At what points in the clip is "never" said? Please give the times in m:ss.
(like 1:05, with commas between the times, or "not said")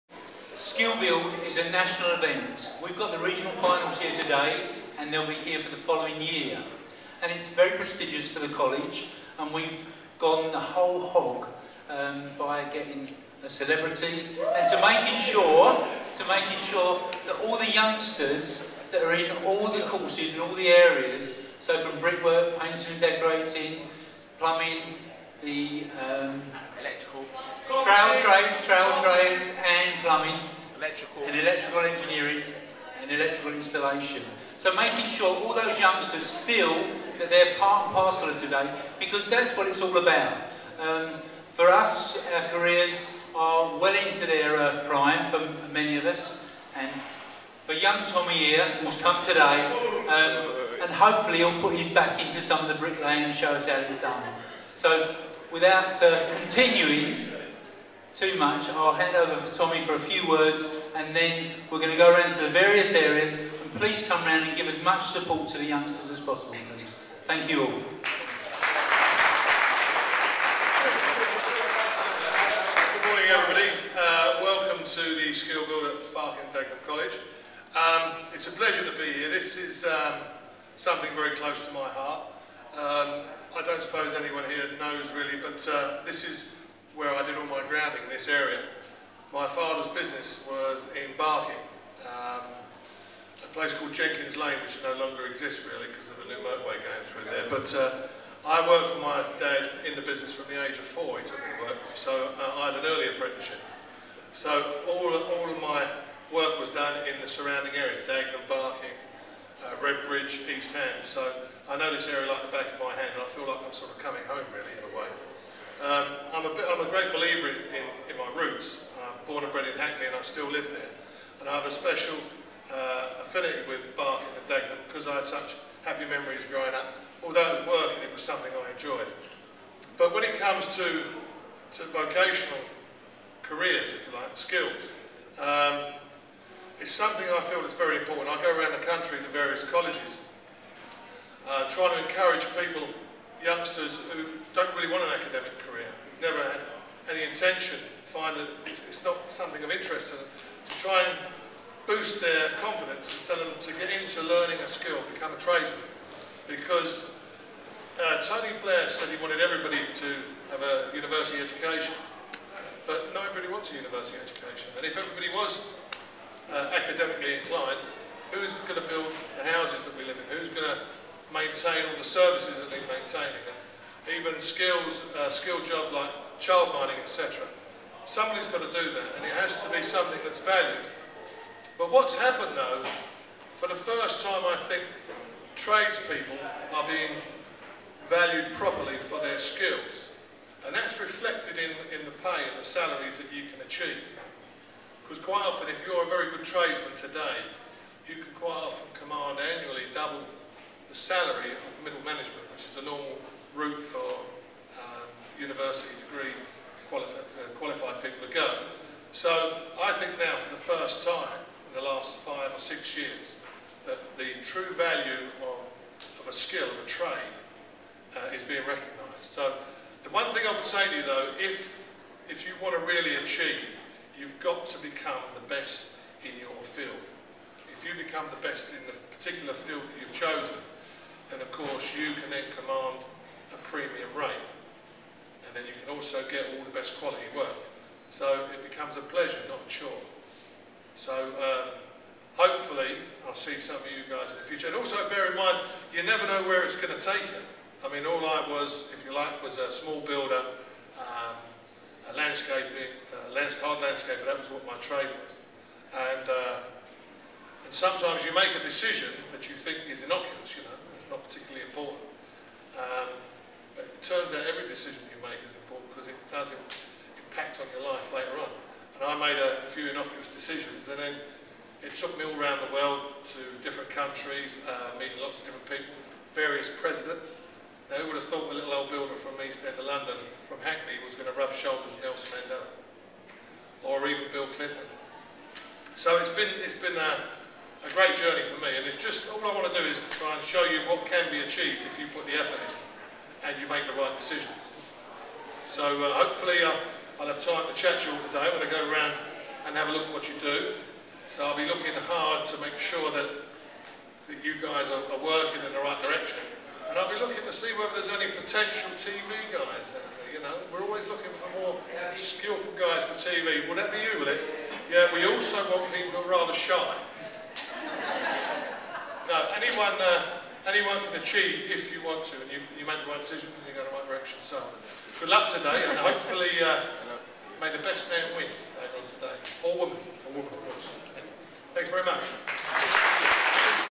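2:26, 4:06.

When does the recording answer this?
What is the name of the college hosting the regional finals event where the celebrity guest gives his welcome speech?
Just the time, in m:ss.
1:16.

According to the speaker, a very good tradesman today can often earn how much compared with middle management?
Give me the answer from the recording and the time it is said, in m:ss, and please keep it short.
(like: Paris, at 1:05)
double the salary, at 3:19.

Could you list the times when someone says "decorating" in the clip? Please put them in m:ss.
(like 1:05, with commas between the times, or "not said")
0:22.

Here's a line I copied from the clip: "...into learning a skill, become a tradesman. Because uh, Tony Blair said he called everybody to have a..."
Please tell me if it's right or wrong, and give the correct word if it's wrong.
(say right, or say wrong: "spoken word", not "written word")
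wrong: "wanted", not "called".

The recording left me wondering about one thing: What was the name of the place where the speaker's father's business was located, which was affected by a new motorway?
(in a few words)
Jenkins Lane.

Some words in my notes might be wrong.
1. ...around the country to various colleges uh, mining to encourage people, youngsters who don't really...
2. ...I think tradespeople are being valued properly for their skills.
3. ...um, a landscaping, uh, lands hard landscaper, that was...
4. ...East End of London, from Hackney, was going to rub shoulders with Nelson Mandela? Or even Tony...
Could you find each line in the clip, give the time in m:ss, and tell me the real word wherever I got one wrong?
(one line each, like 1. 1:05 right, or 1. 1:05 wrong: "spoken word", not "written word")
1. 2:18 wrong: "trying", not "mining"
2. 3:04 right
3. 4:11 right
4. 4:39 wrong: "Bill", not "Tony".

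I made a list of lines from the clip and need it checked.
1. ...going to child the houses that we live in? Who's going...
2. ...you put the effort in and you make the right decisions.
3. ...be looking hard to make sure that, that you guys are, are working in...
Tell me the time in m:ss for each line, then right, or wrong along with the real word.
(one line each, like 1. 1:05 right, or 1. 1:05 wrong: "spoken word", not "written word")
1. 2:48 wrong: "build", not "child"
2. 4:51 right
3. 5:01 right.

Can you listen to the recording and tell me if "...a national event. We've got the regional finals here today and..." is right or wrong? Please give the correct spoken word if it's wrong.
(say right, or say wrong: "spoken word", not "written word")
right.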